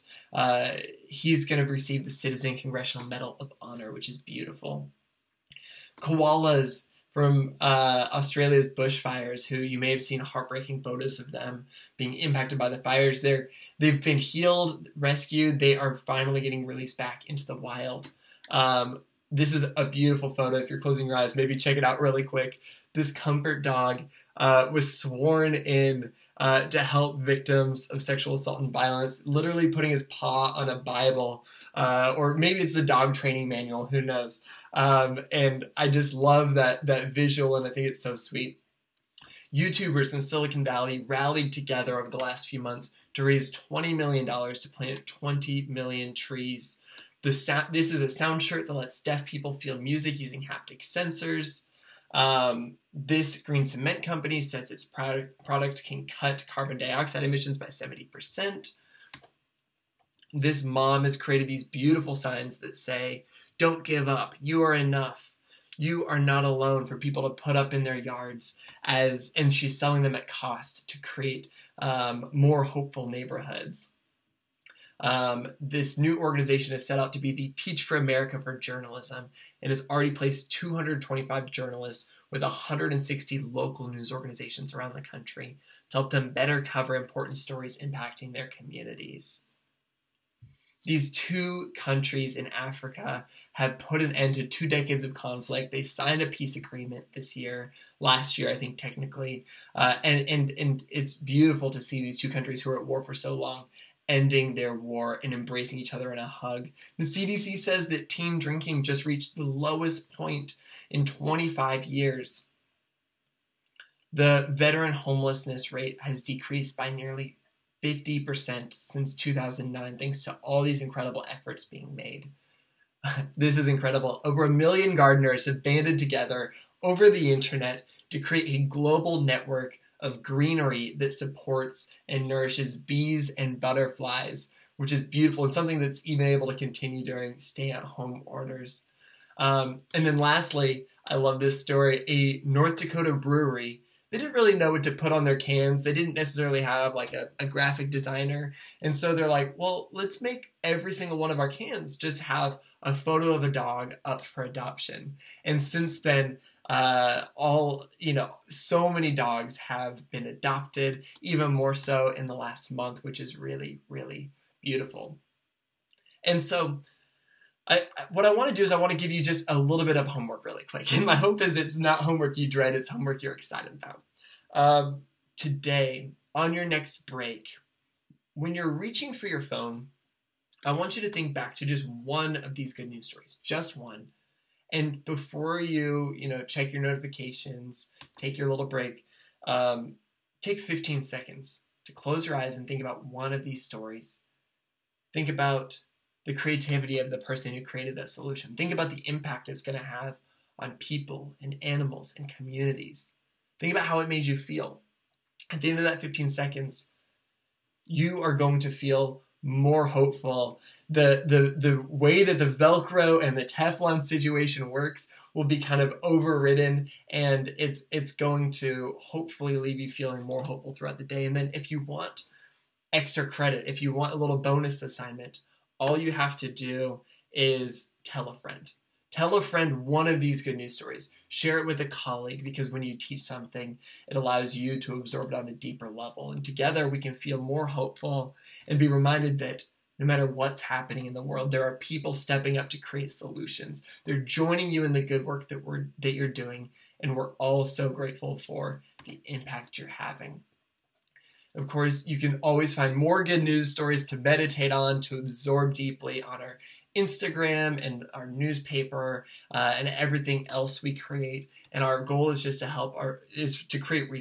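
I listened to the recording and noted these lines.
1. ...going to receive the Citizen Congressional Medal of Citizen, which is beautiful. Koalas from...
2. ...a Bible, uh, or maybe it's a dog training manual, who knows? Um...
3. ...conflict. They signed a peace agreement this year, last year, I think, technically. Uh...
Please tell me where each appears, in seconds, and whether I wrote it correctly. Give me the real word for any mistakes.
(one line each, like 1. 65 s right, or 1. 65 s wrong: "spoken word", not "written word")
1. 1 s wrong: "Honor", not "Citizen"
2. 30 s right
3. 95 s right.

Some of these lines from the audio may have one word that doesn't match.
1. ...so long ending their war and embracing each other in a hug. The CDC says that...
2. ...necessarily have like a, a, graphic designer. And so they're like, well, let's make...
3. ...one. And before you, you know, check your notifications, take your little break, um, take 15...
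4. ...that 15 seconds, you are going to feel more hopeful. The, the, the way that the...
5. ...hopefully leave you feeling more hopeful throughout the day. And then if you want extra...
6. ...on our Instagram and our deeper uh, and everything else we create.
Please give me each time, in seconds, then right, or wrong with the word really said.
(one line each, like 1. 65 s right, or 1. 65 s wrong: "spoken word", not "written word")
1. 103 s right
2. 146 s right
3. 183 s right
4. 205 s right
5. 218 s right
6. 256 s wrong: "newspaper", not "deeper".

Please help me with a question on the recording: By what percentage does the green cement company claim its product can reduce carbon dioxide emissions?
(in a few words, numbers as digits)
70%.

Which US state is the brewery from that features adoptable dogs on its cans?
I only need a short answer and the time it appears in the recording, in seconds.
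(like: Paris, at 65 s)
North Dakota, at 142 s.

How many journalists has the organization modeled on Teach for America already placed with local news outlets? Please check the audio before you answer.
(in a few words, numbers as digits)
225.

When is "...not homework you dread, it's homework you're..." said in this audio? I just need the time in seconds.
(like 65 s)
171 s.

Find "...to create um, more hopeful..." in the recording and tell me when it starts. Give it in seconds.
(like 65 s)
70 s.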